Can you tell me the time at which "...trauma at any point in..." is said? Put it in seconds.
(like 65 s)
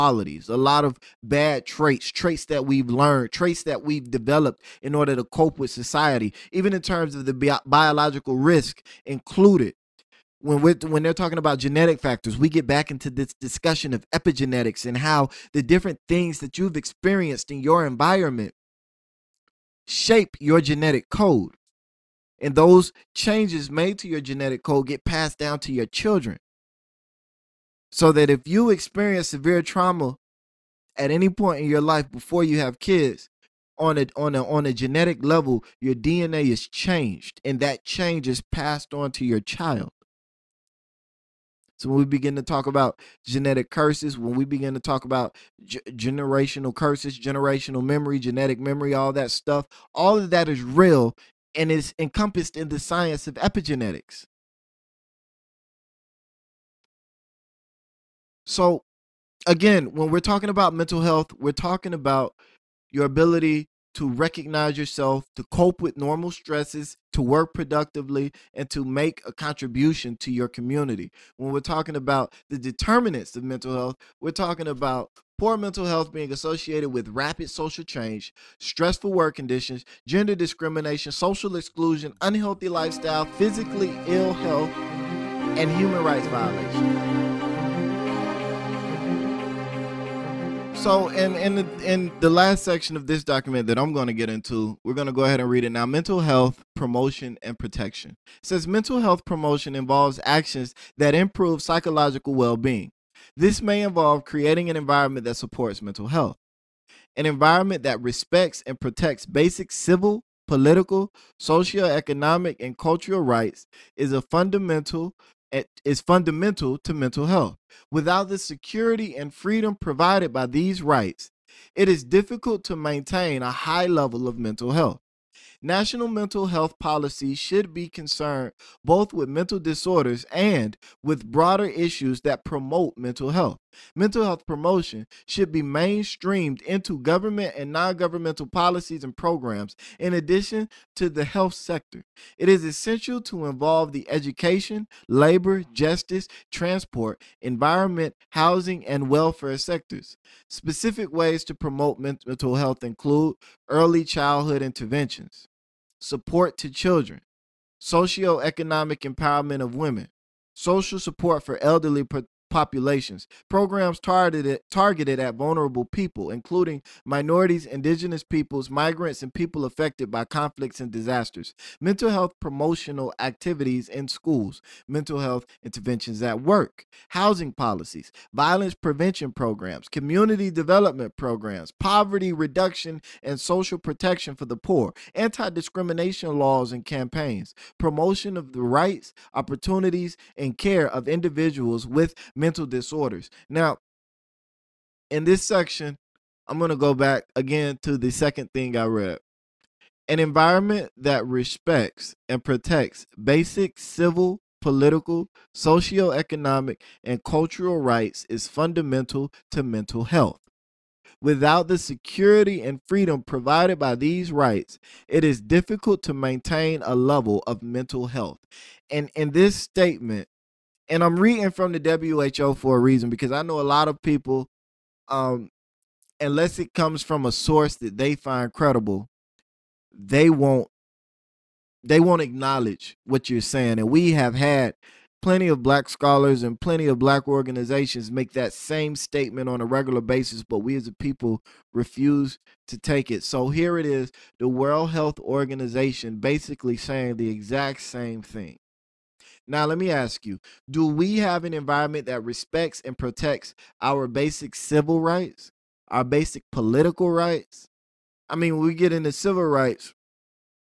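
29 s.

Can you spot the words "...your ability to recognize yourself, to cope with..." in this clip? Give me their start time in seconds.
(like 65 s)
62 s.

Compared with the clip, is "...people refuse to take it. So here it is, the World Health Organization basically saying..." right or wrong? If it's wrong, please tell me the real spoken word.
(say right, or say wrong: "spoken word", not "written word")
right.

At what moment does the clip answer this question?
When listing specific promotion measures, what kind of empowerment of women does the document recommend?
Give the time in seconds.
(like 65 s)
157 s.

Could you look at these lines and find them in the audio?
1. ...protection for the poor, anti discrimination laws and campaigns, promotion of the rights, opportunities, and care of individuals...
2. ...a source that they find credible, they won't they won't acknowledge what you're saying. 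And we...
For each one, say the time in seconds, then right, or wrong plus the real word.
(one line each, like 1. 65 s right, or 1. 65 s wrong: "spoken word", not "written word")
1. 183 s right
2. 227 s right.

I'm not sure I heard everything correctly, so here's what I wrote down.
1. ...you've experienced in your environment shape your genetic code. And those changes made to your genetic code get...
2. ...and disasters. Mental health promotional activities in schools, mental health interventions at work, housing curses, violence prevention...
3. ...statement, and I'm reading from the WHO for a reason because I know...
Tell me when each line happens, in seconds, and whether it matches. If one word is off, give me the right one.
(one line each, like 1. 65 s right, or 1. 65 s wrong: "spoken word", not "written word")
1. 16 s right
2. 170 s wrong: "policies", not "curses"
3. 219 s right.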